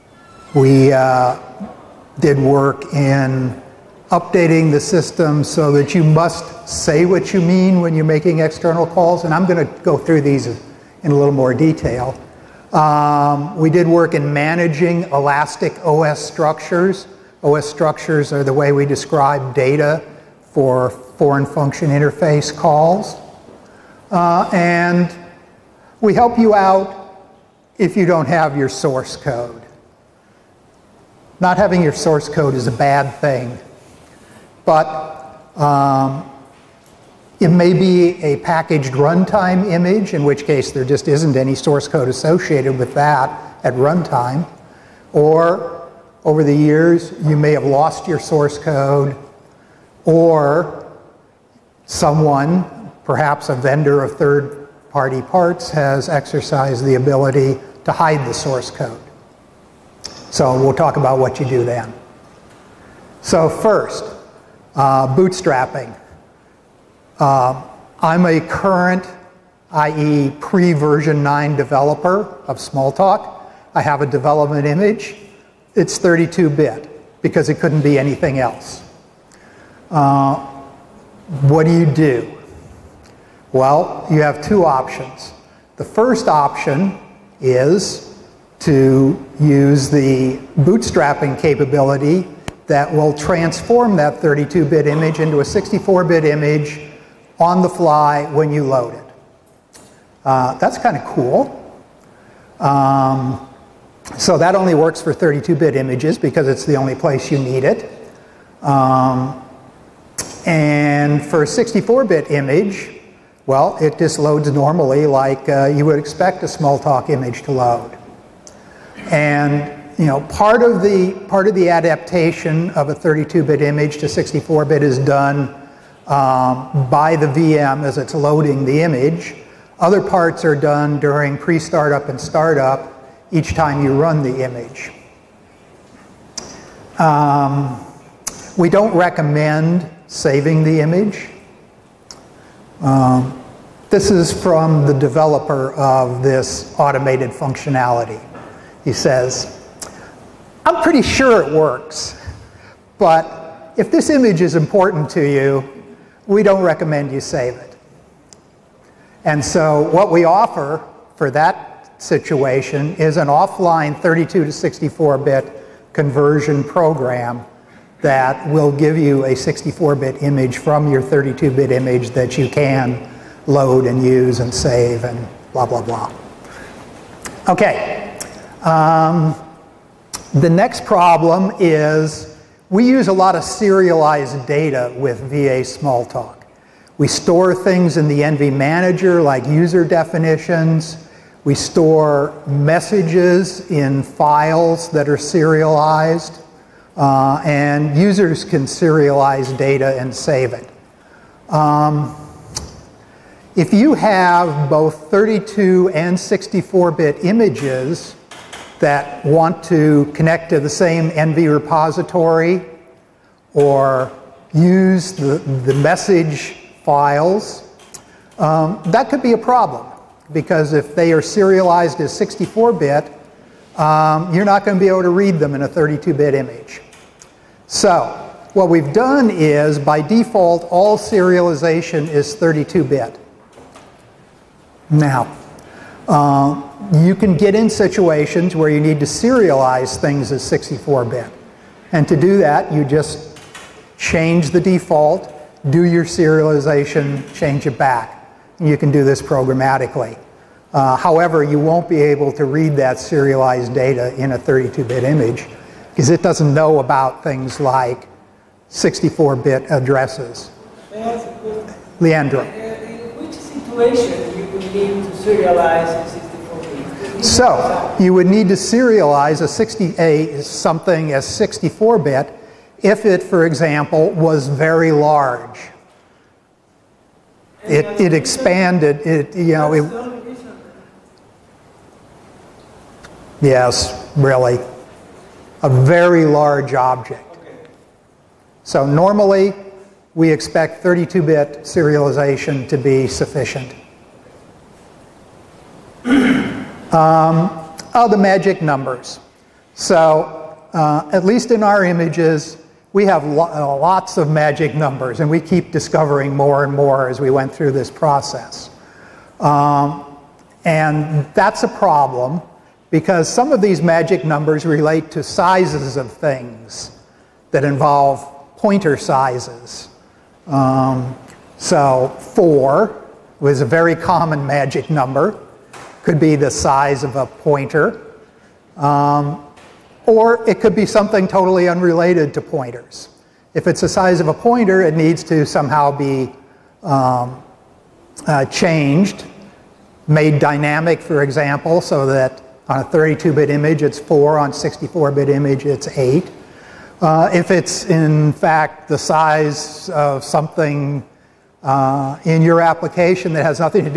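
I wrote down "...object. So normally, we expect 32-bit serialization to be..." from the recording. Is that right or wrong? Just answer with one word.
right.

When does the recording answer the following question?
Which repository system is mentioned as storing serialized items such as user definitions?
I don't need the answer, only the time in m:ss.
3:08.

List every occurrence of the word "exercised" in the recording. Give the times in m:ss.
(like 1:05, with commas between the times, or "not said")
0:56.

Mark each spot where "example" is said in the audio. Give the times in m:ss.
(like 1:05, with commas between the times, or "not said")
4:33, 5:41.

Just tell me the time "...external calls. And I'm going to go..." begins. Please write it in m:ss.
0:08.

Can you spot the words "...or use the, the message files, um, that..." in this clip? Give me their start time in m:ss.
3:33.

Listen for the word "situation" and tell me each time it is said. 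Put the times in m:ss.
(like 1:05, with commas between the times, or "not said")
2:41, 3:57, 4:23.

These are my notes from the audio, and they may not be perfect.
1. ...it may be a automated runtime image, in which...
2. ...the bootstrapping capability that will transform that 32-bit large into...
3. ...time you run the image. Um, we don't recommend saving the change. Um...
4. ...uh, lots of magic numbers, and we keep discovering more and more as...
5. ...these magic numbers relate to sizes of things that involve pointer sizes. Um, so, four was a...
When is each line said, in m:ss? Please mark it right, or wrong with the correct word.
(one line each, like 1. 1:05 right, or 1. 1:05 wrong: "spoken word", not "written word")
1. 0:37 wrong: "packaged", not "automated"
2. 1:29 wrong: "image", not "large"
3. 2:13 wrong: "image", not "change"
4. 5:03 right
5. 5:13 right.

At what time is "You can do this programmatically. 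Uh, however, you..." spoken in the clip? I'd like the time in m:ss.
4:08.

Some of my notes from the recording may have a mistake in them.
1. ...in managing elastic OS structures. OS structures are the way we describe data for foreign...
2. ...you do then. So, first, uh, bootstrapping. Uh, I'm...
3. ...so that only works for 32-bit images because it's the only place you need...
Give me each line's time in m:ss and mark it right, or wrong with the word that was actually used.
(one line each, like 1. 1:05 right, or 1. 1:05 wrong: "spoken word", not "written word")
1. 0:14 right
2. 1:01 right
3. 1:44 right.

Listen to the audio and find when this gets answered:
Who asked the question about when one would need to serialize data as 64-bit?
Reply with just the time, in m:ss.
4:21.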